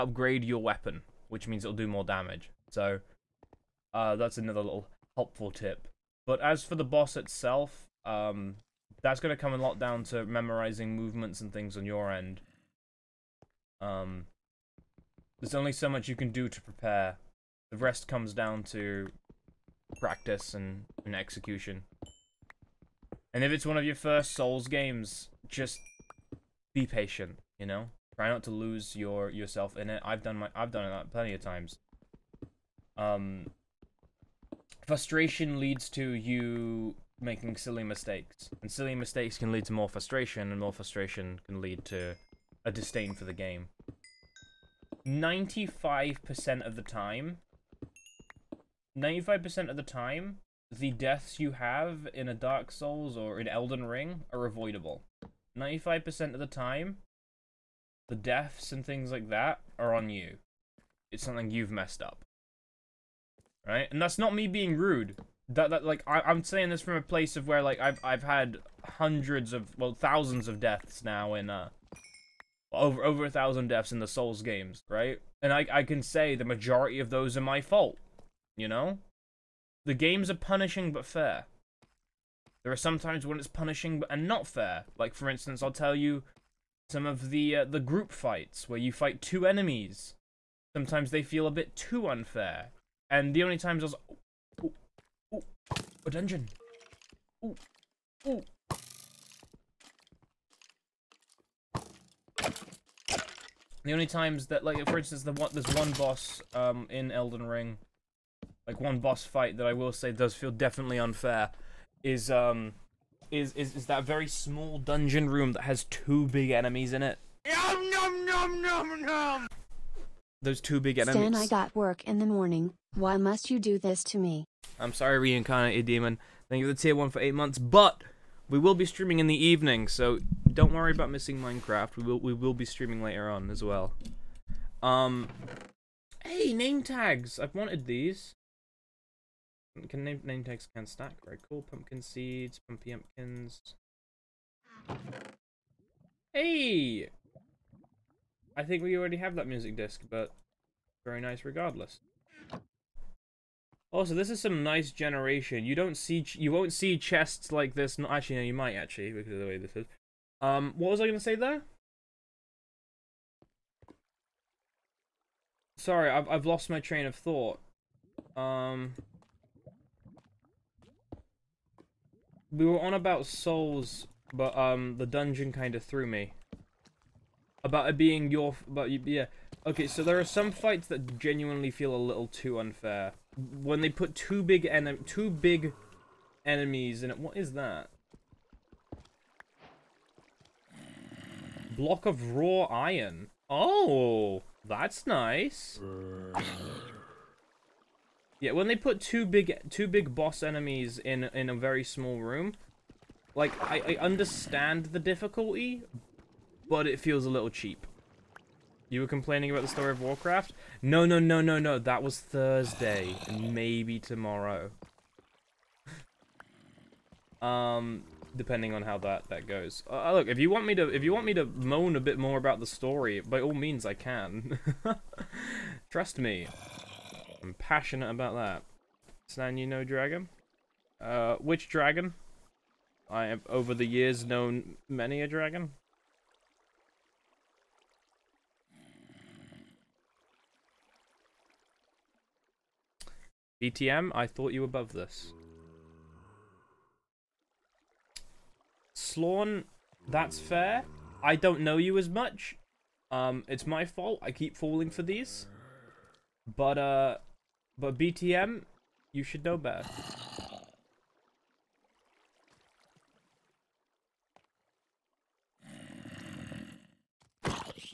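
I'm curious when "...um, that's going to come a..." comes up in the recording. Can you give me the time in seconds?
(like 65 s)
8 s.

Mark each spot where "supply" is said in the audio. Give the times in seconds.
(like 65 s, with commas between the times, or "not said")
not said.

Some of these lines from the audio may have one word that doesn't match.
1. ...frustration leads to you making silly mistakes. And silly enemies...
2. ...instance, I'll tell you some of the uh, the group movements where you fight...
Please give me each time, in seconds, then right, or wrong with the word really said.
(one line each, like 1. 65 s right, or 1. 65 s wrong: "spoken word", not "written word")
1. 34 s wrong: "mistakes", not "enemies"
2. 85 s wrong: "fights", not "movements".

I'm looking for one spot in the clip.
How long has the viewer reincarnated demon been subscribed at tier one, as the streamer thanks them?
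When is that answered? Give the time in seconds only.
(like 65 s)
127 s.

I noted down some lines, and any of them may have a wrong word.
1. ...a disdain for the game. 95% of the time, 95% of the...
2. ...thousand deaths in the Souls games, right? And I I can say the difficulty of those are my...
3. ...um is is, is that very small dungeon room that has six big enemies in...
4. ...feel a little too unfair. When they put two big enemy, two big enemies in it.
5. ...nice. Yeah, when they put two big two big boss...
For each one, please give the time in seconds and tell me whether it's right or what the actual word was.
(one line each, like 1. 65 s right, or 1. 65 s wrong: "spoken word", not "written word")
1. 42 s right
2. 73 s wrong: "majority", not "difficulty"
3. 112 s wrong: "two", not "six"
4. 181 s right
5. 195 s right.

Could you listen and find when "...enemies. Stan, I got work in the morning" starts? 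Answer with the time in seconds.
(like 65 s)
120 s.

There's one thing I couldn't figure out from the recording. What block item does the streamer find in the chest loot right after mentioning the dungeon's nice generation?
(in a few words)
Block of raw iron.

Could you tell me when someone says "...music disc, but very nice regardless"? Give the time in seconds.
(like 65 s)
149 s.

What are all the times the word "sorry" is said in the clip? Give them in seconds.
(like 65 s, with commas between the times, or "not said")
124 s, 165 s.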